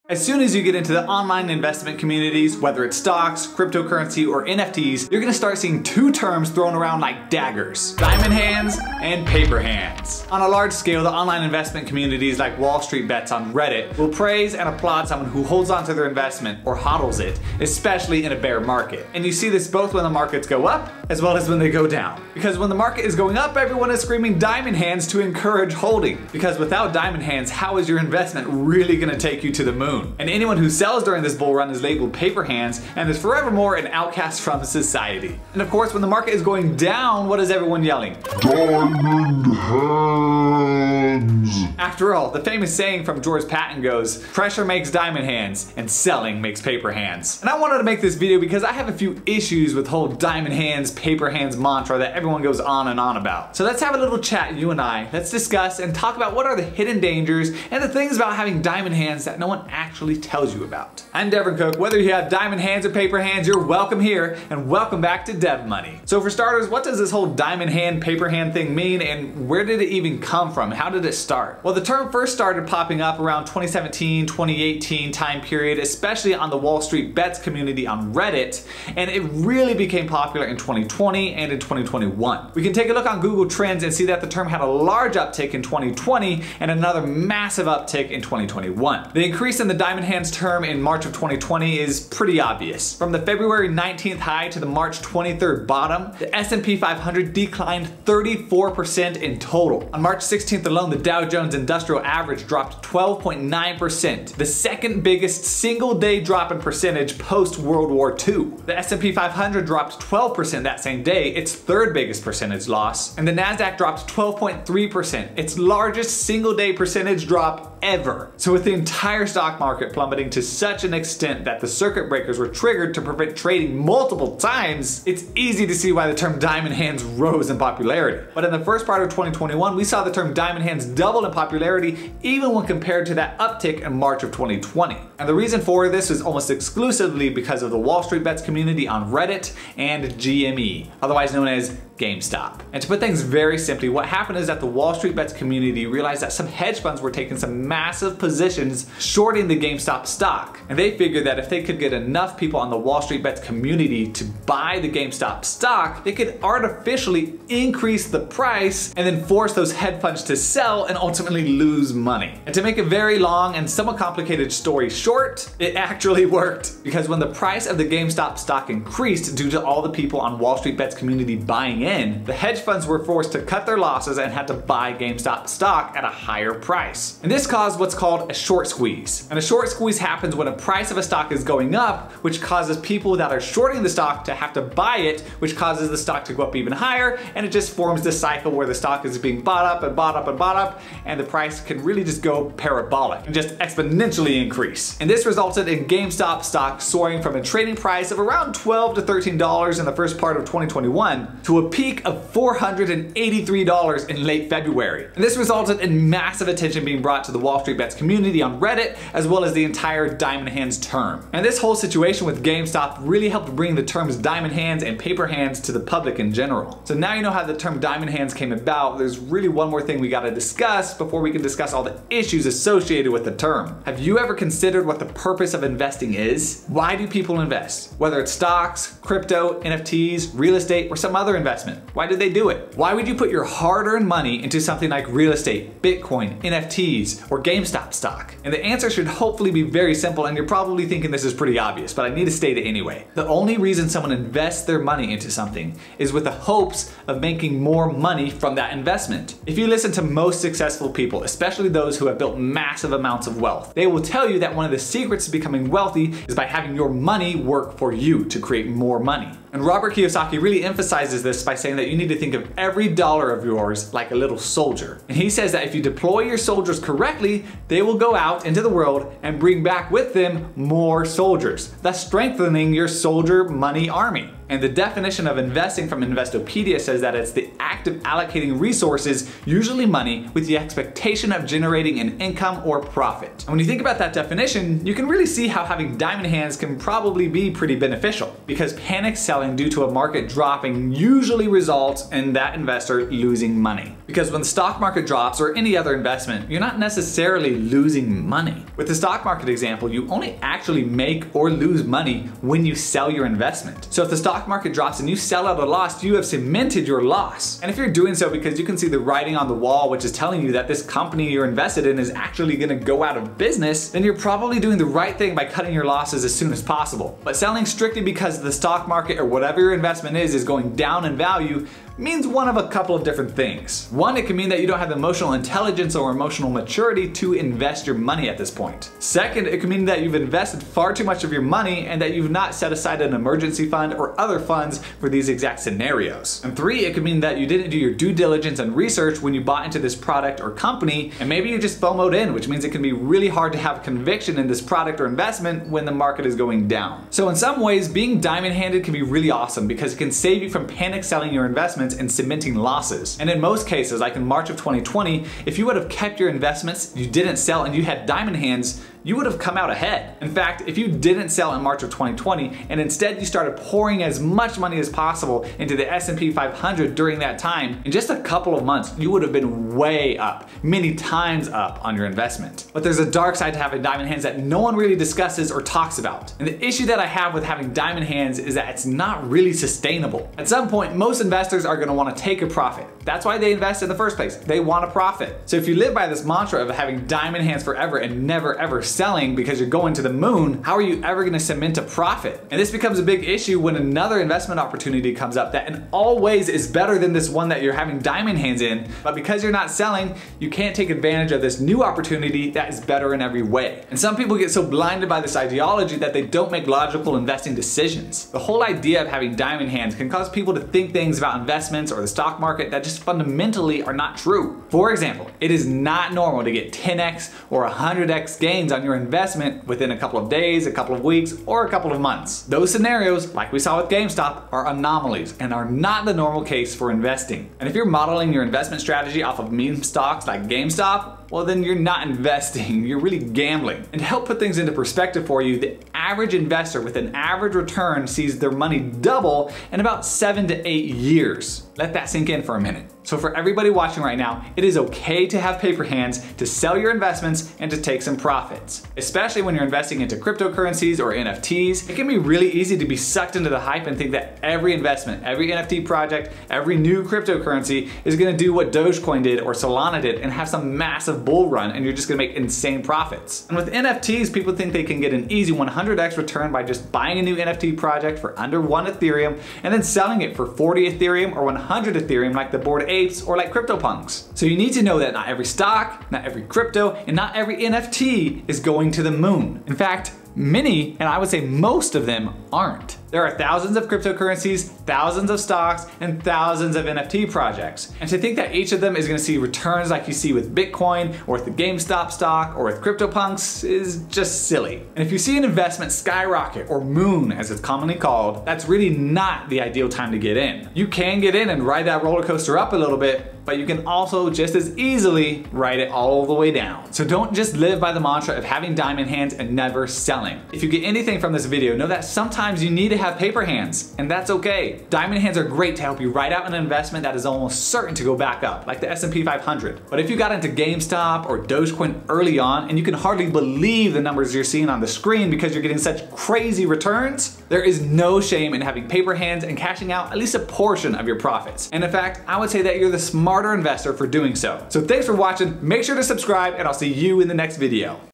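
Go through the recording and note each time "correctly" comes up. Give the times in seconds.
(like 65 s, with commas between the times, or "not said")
266 s.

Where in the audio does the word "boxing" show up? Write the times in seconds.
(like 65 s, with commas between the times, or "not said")
not said.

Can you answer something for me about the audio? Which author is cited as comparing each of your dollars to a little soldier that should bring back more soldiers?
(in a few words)
Robert Kiyosaki.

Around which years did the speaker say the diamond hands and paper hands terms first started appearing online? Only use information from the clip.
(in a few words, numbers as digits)
2017, 2018.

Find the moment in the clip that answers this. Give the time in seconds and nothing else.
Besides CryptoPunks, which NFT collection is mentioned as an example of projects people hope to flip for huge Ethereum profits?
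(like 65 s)
472 s.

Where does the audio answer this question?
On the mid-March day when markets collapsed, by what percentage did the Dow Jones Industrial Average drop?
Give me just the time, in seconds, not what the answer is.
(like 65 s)
102 s.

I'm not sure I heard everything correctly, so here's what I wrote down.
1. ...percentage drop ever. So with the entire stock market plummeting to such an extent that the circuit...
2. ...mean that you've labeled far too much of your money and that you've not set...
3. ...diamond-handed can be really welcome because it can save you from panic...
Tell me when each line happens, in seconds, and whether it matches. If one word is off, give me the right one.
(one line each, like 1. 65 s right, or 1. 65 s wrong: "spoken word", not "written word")
1. 116 s right
2. 329 s wrong: "invested", not "labeled"
3. 348 s wrong: "awesome", not "welcome".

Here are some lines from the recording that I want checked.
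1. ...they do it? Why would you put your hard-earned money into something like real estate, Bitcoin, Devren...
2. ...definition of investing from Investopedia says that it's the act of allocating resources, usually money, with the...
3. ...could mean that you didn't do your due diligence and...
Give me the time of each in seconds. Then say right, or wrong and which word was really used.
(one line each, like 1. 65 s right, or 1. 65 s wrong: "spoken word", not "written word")
1. 232 s wrong: "NFTs", not "Devren"
2. 274 s right
3. 336 s right.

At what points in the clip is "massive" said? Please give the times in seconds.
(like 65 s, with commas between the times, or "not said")
87 s, 147 s, 206 s, 252 s, 460 s.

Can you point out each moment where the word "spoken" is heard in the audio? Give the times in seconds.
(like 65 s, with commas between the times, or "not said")
not said.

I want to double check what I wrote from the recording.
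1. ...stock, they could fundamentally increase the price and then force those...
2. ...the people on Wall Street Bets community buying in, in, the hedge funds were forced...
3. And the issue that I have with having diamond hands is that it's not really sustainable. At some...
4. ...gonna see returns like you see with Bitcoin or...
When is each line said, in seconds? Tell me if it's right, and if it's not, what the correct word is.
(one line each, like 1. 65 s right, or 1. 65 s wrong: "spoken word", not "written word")
1. 155 s wrong: "artificially", not "fundamentally"
2. 169 s right
3. 376 s right
4. 489 s right.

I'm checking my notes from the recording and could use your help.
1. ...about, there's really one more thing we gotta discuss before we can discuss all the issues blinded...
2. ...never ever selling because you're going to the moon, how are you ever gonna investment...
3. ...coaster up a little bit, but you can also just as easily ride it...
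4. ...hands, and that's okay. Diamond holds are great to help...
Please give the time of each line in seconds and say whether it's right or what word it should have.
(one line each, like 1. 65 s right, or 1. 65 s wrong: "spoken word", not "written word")
1. 218 s wrong: "associated", not "blinded"
2. 388 s wrong: "cement", not "investment"
3. 502 s right
4. 513 s wrong: "hands", not "holds".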